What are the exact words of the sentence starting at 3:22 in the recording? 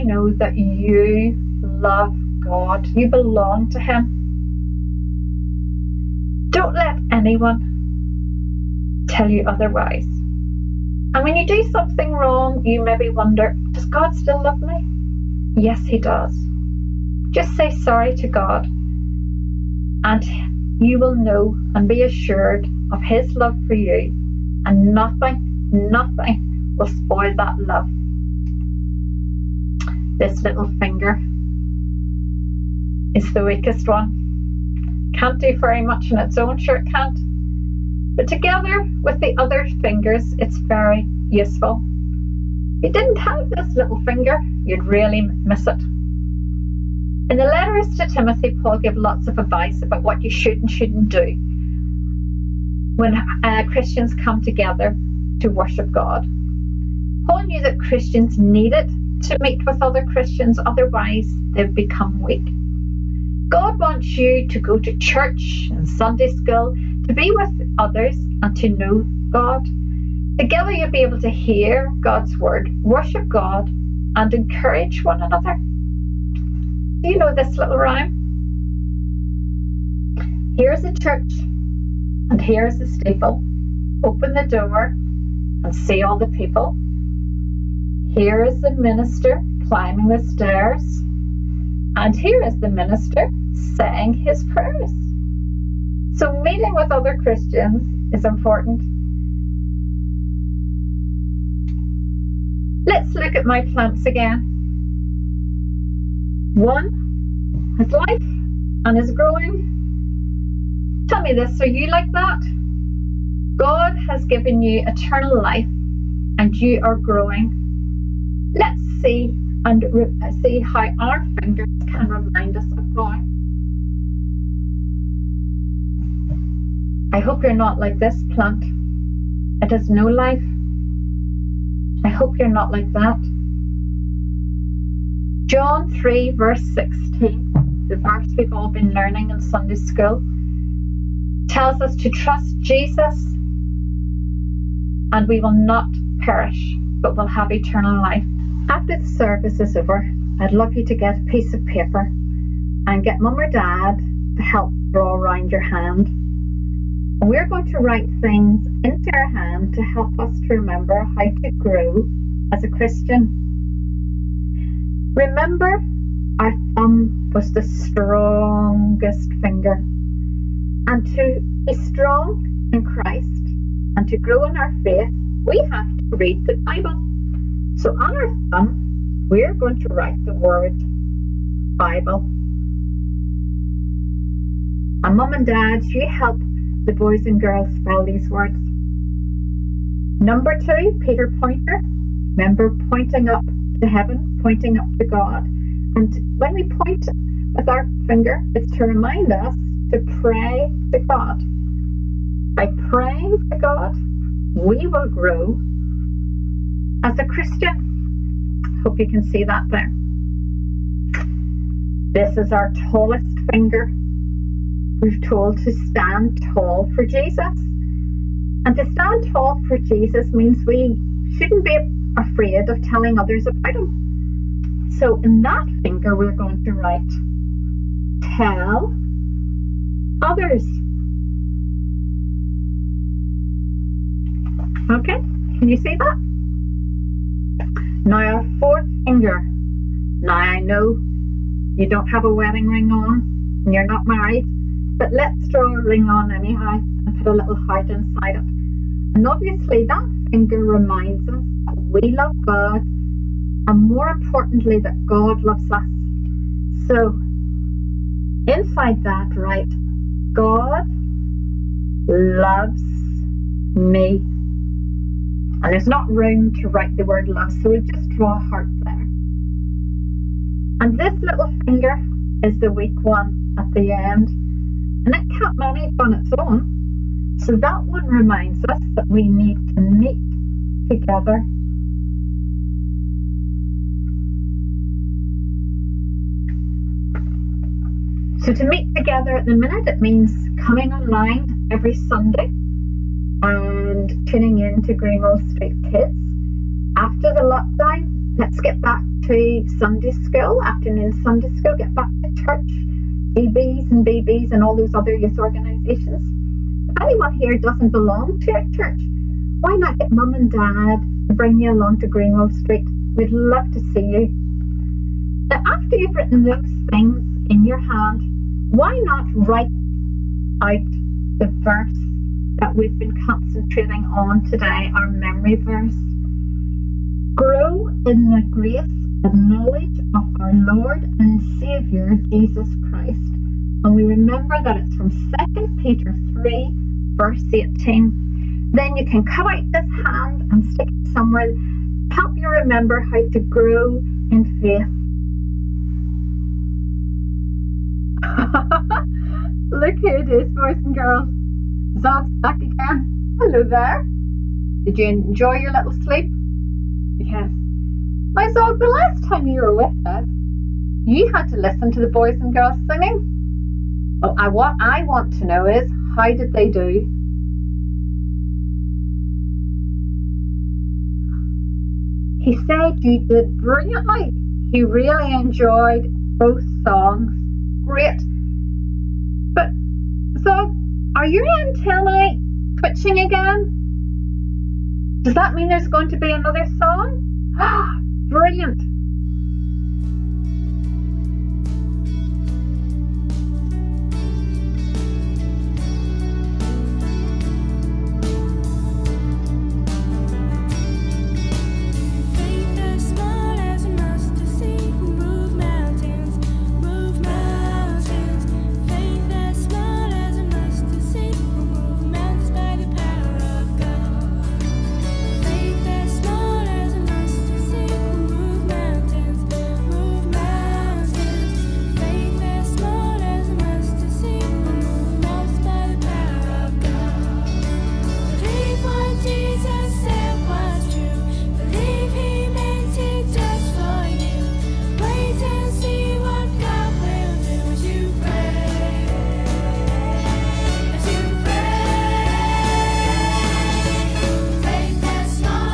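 By praying to God, we will grow as a Christian.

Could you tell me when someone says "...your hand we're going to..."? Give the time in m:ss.
2:35.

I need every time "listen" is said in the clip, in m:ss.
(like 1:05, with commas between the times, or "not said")
6:01.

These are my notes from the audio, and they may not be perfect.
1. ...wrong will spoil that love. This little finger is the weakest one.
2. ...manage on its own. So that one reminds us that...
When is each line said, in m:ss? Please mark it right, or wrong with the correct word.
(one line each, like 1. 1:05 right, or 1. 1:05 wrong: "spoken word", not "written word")
1. 0:25 wrong: "nothing", not "wrong"
2. 4:35 right.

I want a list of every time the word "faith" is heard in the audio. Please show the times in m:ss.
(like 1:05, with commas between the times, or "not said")
2:54, 5:44.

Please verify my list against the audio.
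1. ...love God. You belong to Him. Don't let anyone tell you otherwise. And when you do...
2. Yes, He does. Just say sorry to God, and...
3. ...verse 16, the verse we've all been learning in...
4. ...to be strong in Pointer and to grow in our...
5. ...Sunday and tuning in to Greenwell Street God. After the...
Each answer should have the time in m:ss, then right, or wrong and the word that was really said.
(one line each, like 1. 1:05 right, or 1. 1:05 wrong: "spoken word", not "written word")
1. 0:01 right
2. 0:15 right
3. 2:16 right
4. 2:51 wrong: "Christ", not "Pointer"
5. 4:51 wrong: "Kids", not "God".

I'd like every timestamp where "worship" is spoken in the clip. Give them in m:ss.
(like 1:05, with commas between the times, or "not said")
0:55, 1:12.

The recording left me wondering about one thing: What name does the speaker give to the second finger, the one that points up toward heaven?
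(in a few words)
Peter Pointer.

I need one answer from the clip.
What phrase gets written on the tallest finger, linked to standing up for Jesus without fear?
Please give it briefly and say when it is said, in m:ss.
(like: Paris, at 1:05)
tell others, at 3:48.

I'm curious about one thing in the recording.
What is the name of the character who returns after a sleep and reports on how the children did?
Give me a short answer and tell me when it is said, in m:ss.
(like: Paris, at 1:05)
Zog, at 5:51.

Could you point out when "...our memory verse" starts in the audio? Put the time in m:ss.
5:24.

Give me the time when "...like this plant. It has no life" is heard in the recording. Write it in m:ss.
2:07.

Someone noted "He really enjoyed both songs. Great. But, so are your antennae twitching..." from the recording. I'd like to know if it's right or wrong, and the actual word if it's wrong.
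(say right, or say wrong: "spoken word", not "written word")
right.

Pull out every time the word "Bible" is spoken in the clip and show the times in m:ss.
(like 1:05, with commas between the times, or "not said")
2:56, 3:01.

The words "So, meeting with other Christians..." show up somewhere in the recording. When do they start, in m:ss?
1:36.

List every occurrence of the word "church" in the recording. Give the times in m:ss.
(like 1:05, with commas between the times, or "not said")
1:04, 1:20, 5:02, 5:08.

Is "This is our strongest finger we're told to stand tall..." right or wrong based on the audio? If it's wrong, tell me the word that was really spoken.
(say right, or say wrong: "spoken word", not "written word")
wrong: "tallest", not "strongest".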